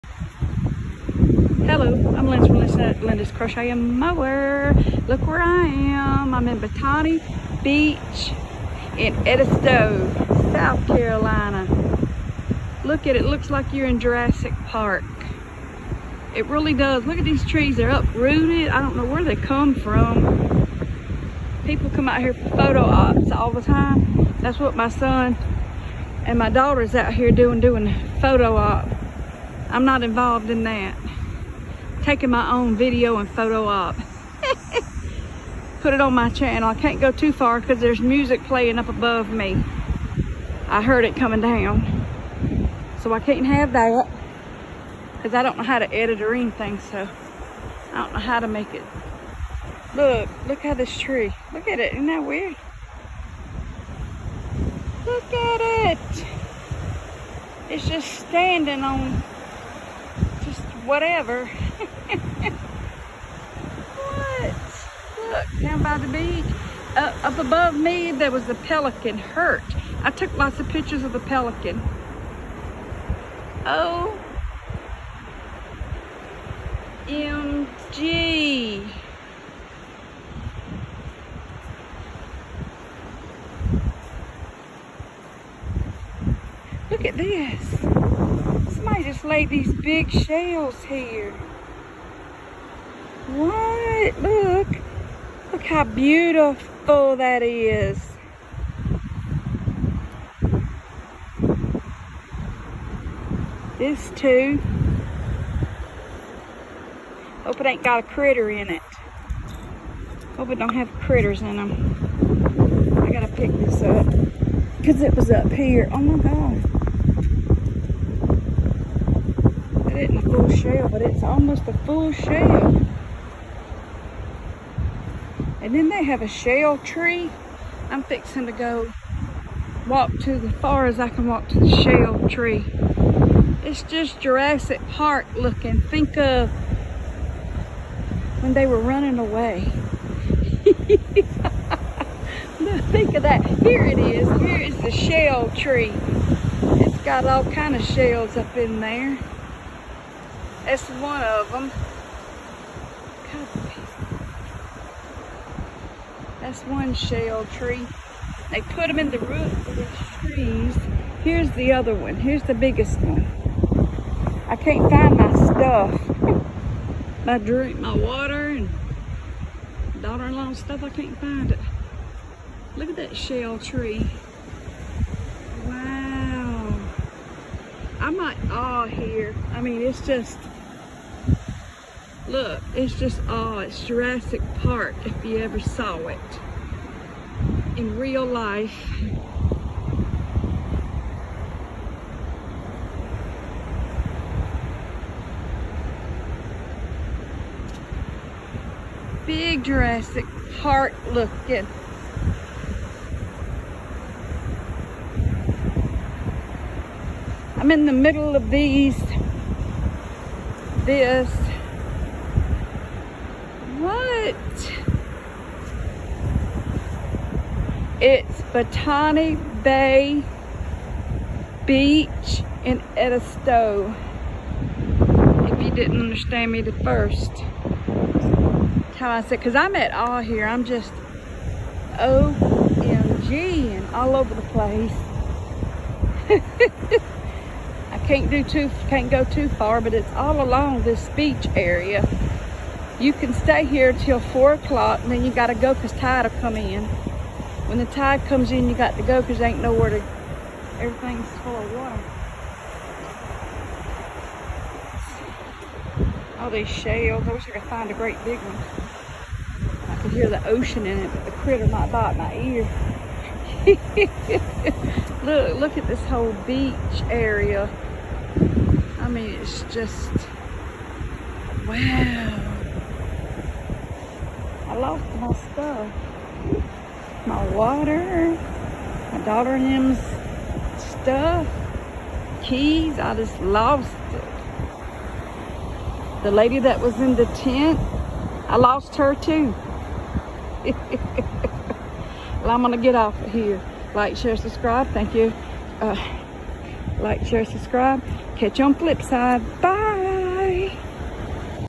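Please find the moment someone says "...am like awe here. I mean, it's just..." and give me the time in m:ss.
2:58.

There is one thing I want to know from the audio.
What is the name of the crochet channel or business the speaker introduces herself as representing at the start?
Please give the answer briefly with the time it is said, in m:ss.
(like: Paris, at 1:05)
Linda's Crochet and More, at 0:03.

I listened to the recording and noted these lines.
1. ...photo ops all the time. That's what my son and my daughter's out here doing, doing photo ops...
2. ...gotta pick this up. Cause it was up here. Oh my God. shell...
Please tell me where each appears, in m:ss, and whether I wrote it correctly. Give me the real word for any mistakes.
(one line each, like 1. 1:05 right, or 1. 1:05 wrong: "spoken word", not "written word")
1. 0:22 right
2. 1:53 right.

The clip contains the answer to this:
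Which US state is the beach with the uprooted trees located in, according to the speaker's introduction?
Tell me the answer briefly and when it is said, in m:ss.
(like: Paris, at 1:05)
South Carolina, at 0:10.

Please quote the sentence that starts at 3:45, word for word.
If you didn't understand me the first time I said, because I'm at all here.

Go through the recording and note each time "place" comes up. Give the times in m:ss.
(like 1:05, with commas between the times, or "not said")
3:54.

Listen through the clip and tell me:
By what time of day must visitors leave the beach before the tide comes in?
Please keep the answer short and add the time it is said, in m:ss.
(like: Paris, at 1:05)
4 o'clock, at 4:04.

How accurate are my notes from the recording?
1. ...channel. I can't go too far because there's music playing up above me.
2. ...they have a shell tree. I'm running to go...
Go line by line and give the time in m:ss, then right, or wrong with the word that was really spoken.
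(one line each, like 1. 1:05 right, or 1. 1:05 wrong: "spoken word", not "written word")
1. 0:36 right
2. 2:05 wrong: "fixing", not "running".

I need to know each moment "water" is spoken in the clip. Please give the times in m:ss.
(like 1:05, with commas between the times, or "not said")
2:47, 4:11, 4:37.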